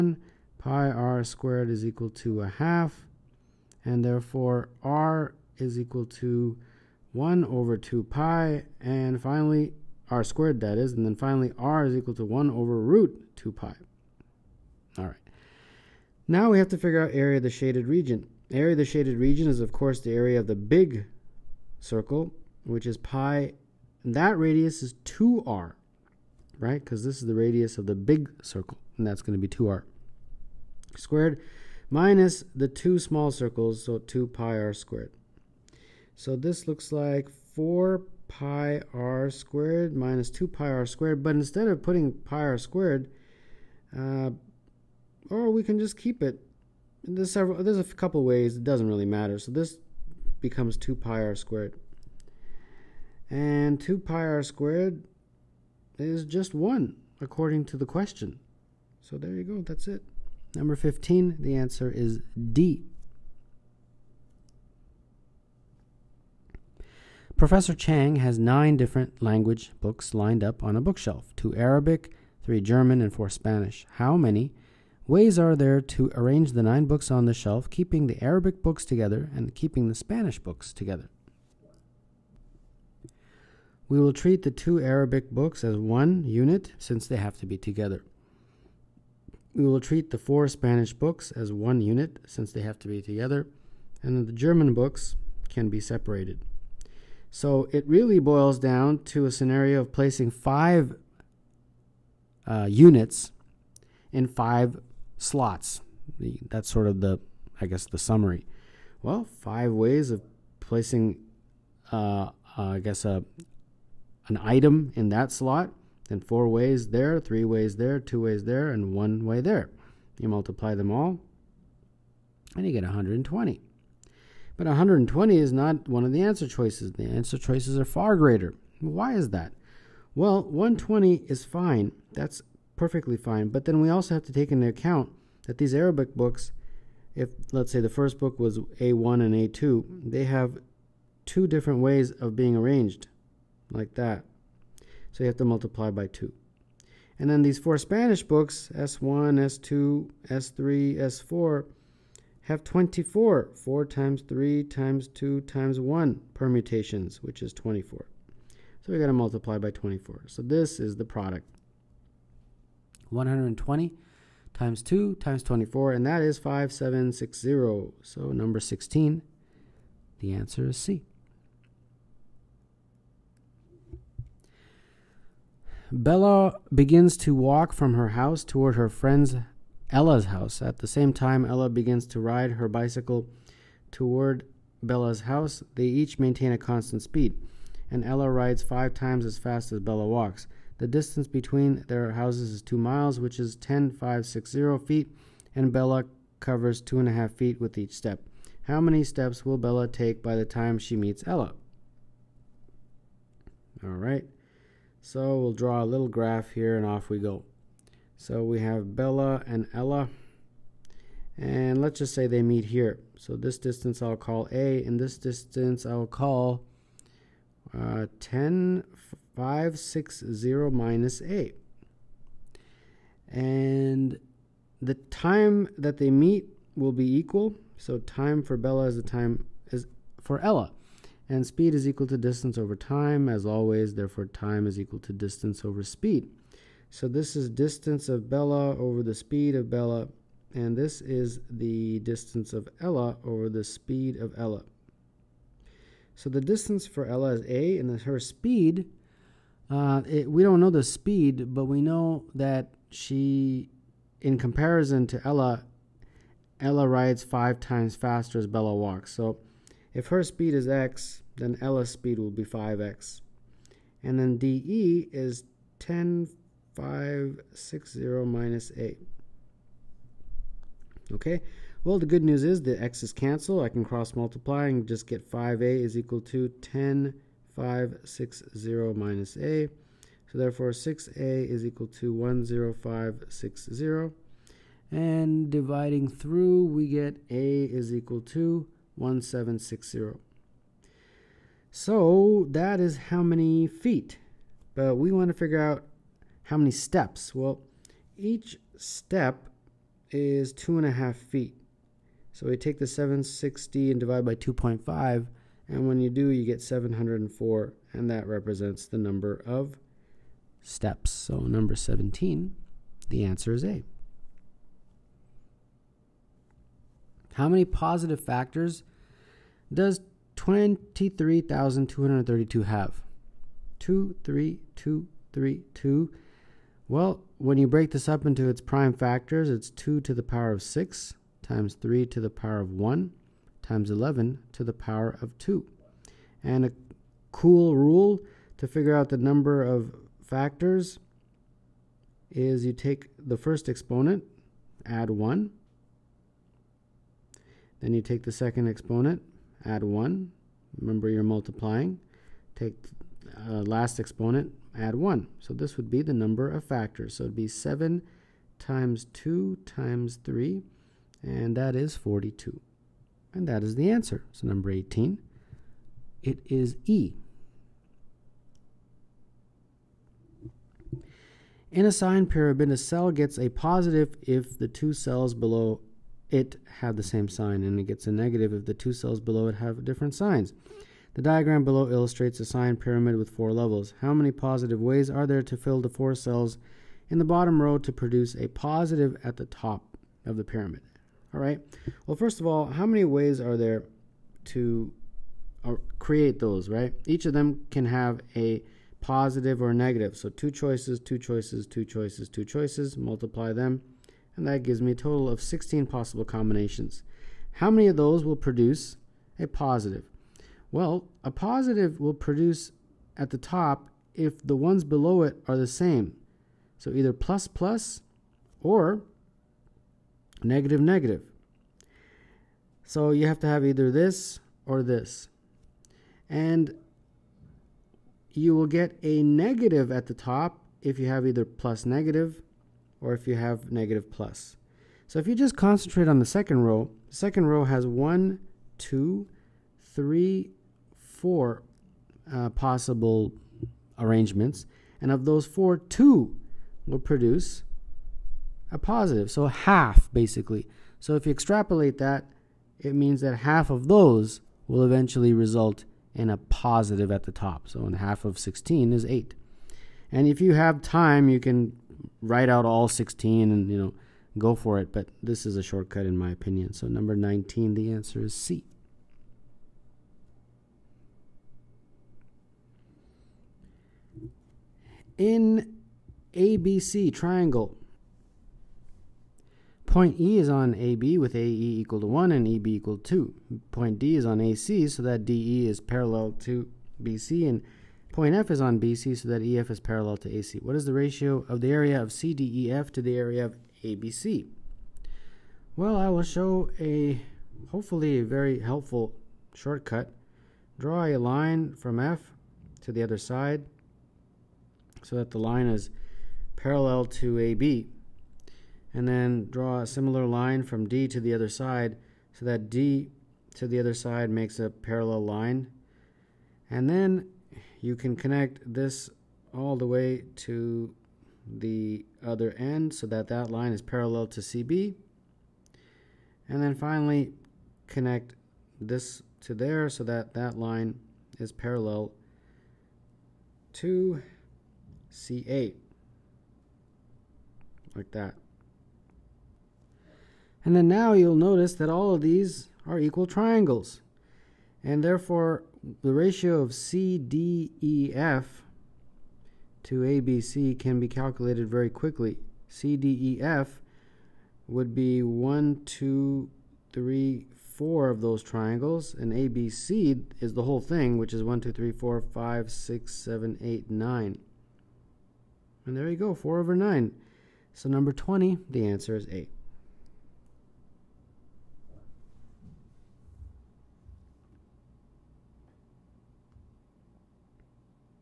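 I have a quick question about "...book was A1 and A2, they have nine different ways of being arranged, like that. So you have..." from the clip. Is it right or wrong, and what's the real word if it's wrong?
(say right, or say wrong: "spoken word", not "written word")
wrong: "two", not "nine".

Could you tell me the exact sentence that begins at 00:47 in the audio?
There's, several, there's a couple ways, it doesn't really matter.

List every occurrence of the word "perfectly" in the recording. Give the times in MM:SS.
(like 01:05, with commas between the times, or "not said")
02:12.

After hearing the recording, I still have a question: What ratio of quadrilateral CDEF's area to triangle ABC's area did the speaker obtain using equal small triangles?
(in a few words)
4/9.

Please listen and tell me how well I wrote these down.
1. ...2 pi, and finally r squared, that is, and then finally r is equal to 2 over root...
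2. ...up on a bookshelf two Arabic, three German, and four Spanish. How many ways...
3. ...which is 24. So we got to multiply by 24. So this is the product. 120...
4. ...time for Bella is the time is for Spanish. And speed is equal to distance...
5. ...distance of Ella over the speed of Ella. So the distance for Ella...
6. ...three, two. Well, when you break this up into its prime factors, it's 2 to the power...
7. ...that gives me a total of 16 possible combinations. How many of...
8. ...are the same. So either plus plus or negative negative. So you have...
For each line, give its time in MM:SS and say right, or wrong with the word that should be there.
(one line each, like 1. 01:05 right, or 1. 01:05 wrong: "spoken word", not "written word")
1. 00:07 wrong: "1", not "2"
2. 01:10 right
3. 02:37 right
4. 03:47 wrong: "Ella", not "Spanish"
5. 04:02 right
6. 05:25 right
7. 06:44 right
8. 06:55 right.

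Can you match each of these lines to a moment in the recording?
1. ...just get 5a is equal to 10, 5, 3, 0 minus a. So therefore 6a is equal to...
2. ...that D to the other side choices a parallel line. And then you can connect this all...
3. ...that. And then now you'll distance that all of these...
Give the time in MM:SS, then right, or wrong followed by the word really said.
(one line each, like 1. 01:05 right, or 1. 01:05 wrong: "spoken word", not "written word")
1. 04:34 wrong: "6", not "3"
2. 08:32 wrong: "makes", not "choices"
3. 08:58 wrong: "notice", not "distance".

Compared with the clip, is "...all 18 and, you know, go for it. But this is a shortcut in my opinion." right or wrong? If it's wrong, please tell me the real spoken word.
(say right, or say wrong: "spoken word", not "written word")
wrong: "16", not "18".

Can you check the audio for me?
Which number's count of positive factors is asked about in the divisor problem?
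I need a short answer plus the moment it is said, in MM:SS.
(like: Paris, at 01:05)
23,232, at 05:20.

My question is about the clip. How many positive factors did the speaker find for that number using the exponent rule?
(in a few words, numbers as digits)
42.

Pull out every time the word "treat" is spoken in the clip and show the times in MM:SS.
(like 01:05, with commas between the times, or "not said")
01:24, 01:29.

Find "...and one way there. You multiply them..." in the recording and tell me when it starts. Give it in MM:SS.
01:58.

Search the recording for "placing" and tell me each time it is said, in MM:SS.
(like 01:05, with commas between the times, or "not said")
01:39, 01:50.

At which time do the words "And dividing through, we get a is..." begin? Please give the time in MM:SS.
04:44.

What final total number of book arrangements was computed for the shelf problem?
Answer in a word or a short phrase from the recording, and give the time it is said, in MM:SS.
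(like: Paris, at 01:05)
5760, at 02:46.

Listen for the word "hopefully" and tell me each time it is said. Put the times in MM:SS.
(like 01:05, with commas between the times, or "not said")
08:17.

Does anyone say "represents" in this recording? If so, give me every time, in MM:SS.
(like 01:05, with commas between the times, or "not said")
05:08.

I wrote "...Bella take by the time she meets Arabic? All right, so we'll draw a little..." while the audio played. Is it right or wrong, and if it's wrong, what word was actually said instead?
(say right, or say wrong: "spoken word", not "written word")
wrong: "Ella", not "Arabic".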